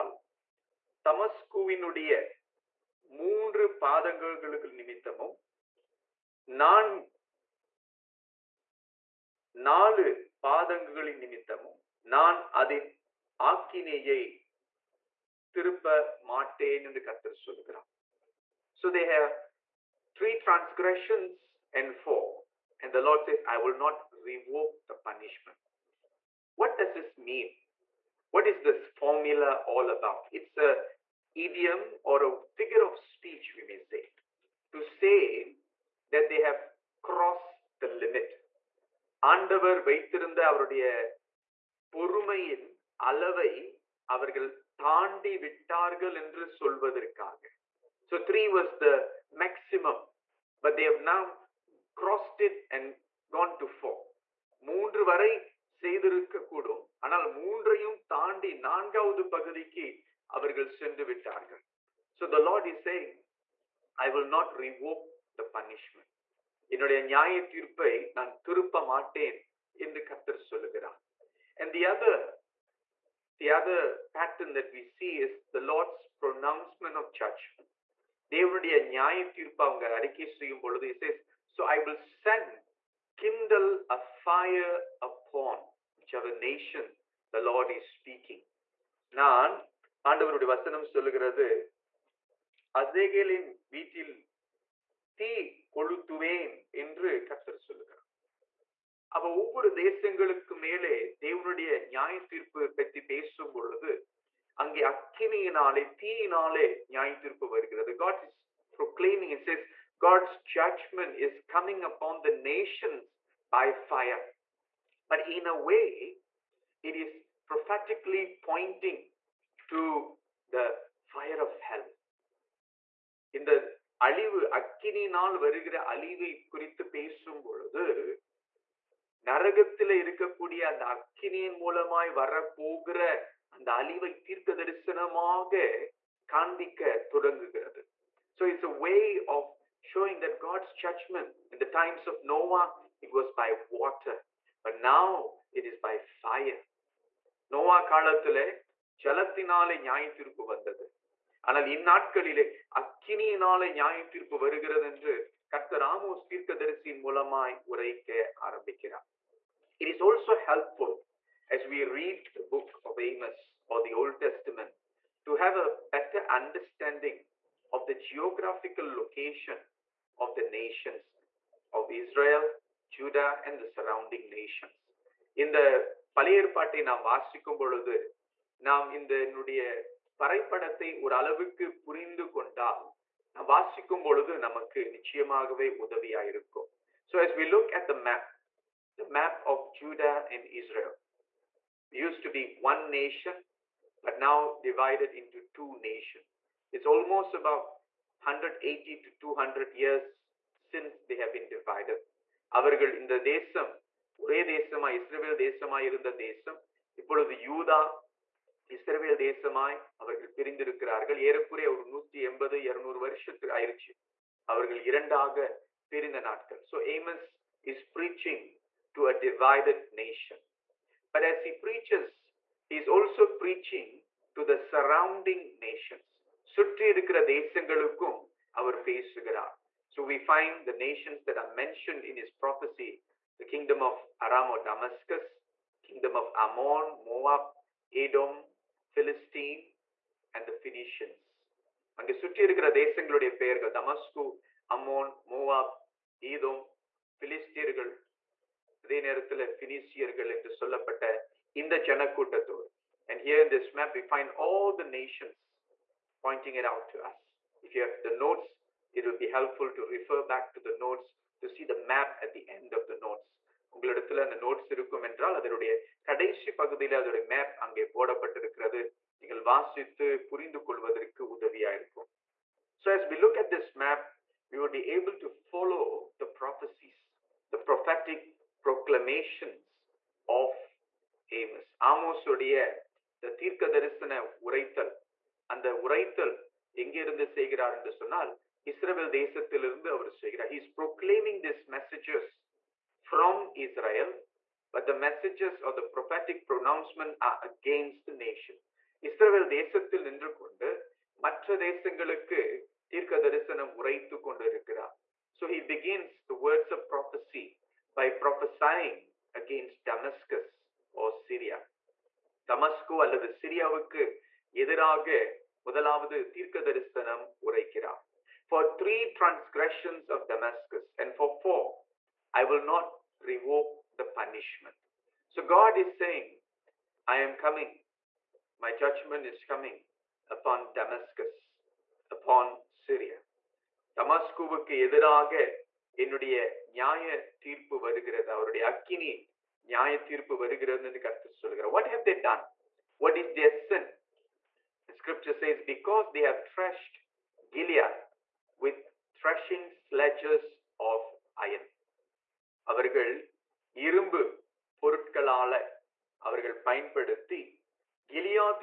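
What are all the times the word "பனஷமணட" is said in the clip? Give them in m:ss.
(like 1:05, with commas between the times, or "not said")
1:05.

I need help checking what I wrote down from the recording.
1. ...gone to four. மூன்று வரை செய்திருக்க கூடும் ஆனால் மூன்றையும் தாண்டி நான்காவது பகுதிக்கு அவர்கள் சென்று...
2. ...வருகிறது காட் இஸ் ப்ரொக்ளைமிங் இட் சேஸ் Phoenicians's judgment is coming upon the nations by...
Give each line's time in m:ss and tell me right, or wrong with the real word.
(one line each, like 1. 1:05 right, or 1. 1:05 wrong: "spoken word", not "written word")
1. 0:53 right
2. 1:47 wrong: "God", not "Phoenicians".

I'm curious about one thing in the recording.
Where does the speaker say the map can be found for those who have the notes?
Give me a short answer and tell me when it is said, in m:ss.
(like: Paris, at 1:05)
at the end of the notes, at 4:22.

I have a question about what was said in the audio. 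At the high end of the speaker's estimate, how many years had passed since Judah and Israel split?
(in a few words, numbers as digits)
200.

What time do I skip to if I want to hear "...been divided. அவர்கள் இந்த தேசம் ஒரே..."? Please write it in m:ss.
3:21.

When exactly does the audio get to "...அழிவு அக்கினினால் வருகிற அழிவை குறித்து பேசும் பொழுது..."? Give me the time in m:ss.
2:04.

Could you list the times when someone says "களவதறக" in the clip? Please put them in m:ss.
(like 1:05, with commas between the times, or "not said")
4:30.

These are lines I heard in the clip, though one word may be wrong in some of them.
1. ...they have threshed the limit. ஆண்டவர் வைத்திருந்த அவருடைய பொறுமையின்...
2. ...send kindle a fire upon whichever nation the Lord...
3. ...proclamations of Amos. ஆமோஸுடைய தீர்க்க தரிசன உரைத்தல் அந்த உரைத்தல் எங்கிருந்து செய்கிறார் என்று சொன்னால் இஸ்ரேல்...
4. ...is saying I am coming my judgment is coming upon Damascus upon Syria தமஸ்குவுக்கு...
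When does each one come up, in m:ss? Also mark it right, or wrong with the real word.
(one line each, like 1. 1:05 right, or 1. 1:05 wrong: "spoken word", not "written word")
1. 0:36 wrong: "crossed", not "threshed"
2. 1:22 right
3. 4:38 right
4. 5:25 right.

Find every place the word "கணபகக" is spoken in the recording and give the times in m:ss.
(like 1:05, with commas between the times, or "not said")
2:16.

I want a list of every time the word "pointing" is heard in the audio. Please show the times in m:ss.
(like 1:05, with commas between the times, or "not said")
1:58, 4:16.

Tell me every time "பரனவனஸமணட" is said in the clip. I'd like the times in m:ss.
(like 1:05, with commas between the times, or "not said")
1:16, 4:56.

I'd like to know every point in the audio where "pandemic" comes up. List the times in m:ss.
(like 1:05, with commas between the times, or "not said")
not said.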